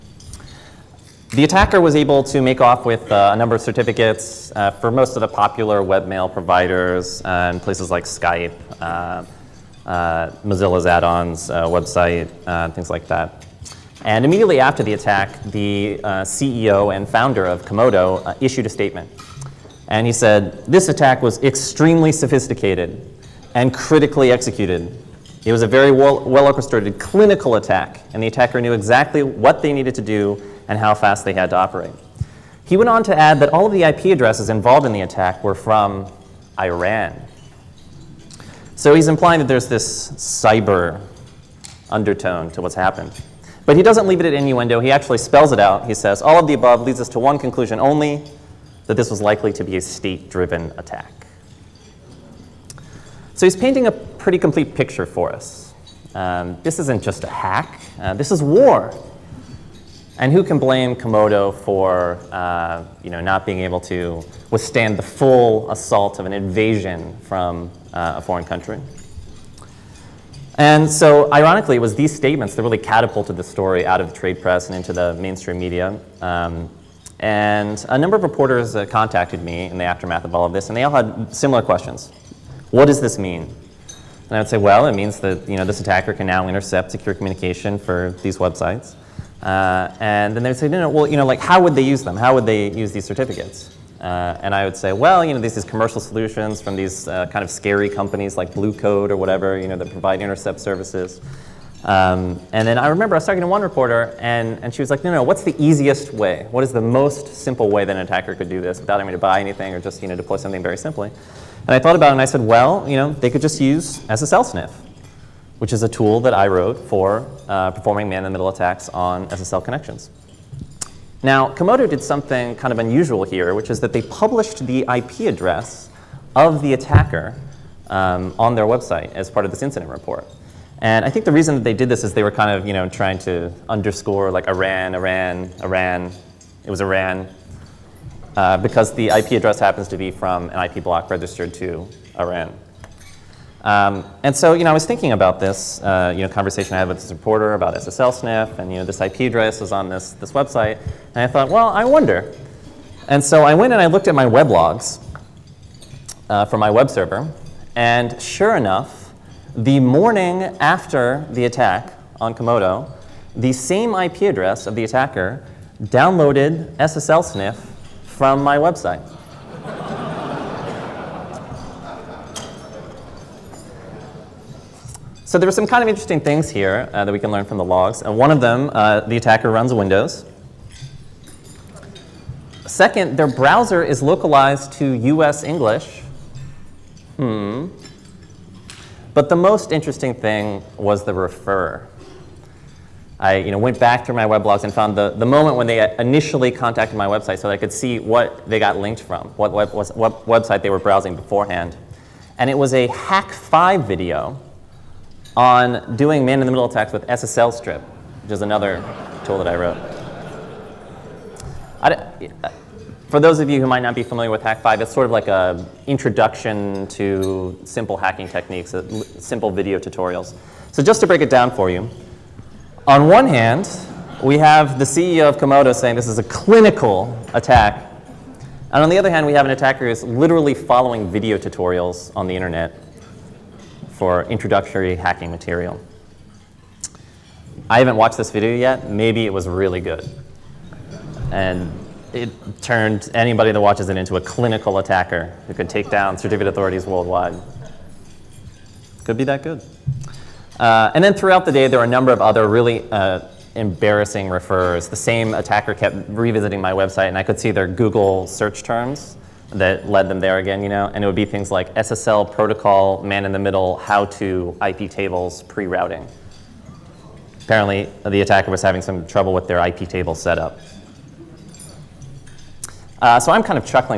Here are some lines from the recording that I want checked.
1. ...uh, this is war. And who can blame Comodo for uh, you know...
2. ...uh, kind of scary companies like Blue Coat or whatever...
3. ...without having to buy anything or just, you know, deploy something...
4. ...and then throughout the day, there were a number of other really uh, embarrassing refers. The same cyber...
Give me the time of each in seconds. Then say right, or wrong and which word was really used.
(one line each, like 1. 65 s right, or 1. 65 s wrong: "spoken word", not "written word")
1. 58 s right
2. 97 s right
3. 108 s right
4. 250 s wrong: "attacker", not "cyber".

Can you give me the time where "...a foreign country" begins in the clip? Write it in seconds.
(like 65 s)
68 s.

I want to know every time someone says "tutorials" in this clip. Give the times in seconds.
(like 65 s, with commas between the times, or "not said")
219 s, 231 s.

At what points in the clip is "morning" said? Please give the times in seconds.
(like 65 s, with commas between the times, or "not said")
159 s.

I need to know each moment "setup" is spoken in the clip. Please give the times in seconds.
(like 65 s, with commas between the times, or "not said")
270 s.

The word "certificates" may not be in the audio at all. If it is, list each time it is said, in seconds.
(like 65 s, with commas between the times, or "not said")
3 s, 93 s, 246 s.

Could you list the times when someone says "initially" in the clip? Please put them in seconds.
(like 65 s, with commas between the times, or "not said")
195 s.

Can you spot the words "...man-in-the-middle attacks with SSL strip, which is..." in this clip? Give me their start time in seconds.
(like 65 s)
206 s.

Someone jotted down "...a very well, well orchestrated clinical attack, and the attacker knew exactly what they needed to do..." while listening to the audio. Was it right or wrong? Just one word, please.
right.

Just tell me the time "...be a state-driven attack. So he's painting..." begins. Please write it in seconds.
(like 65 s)
49 s.